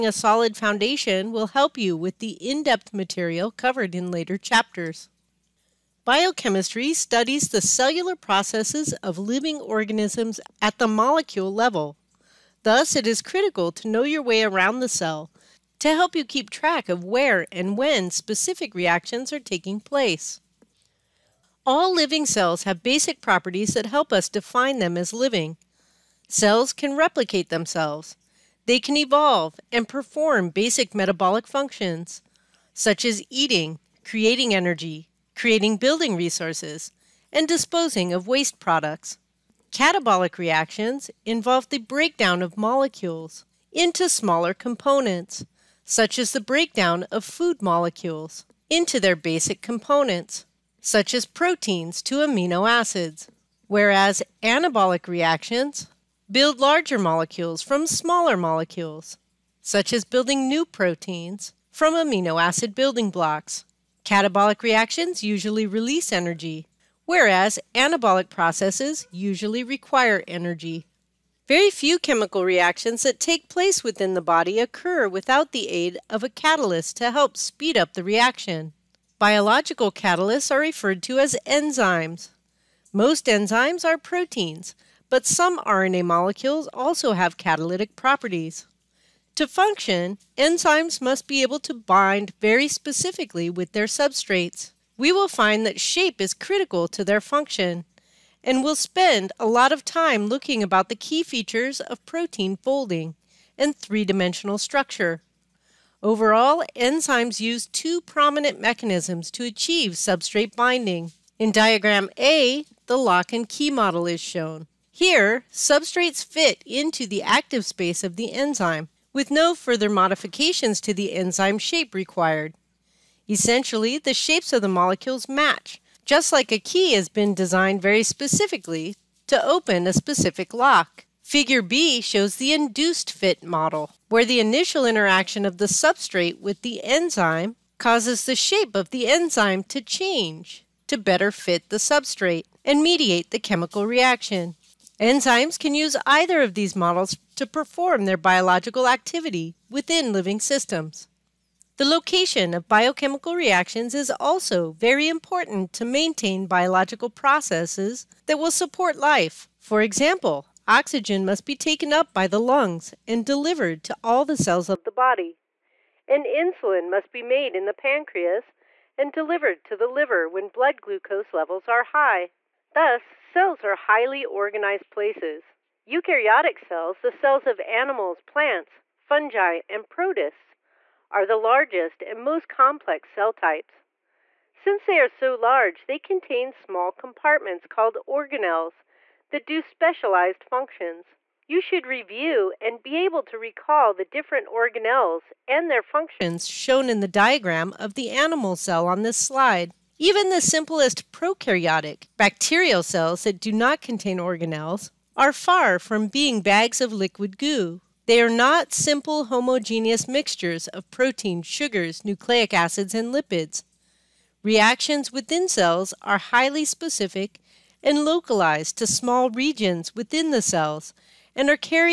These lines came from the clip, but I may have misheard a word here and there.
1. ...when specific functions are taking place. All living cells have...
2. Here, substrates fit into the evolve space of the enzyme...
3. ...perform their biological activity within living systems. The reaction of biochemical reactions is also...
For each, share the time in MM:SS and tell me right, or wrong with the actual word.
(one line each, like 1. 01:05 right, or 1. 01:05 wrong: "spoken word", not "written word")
1. 00:17 wrong: "reactions", not "functions"
2. 01:54 wrong: "active", not "evolve"
3. 02:27 wrong: "location", not "reaction".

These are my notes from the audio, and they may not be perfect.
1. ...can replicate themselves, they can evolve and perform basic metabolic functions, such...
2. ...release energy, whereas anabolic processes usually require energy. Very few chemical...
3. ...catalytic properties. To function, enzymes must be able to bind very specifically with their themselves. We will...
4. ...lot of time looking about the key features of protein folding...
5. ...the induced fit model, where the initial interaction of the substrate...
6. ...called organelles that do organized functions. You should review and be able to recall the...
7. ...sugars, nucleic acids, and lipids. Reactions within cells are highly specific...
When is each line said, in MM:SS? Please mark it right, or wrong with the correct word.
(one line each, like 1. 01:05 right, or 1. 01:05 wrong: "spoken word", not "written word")
1. 00:26 right
2. 01:05 right
3. 01:27 wrong: "substrates", not "themselves"
4. 01:39 right
5. 02:12 right
6. 03:07 wrong: "specialized", not "organized"
7. 03:31 right.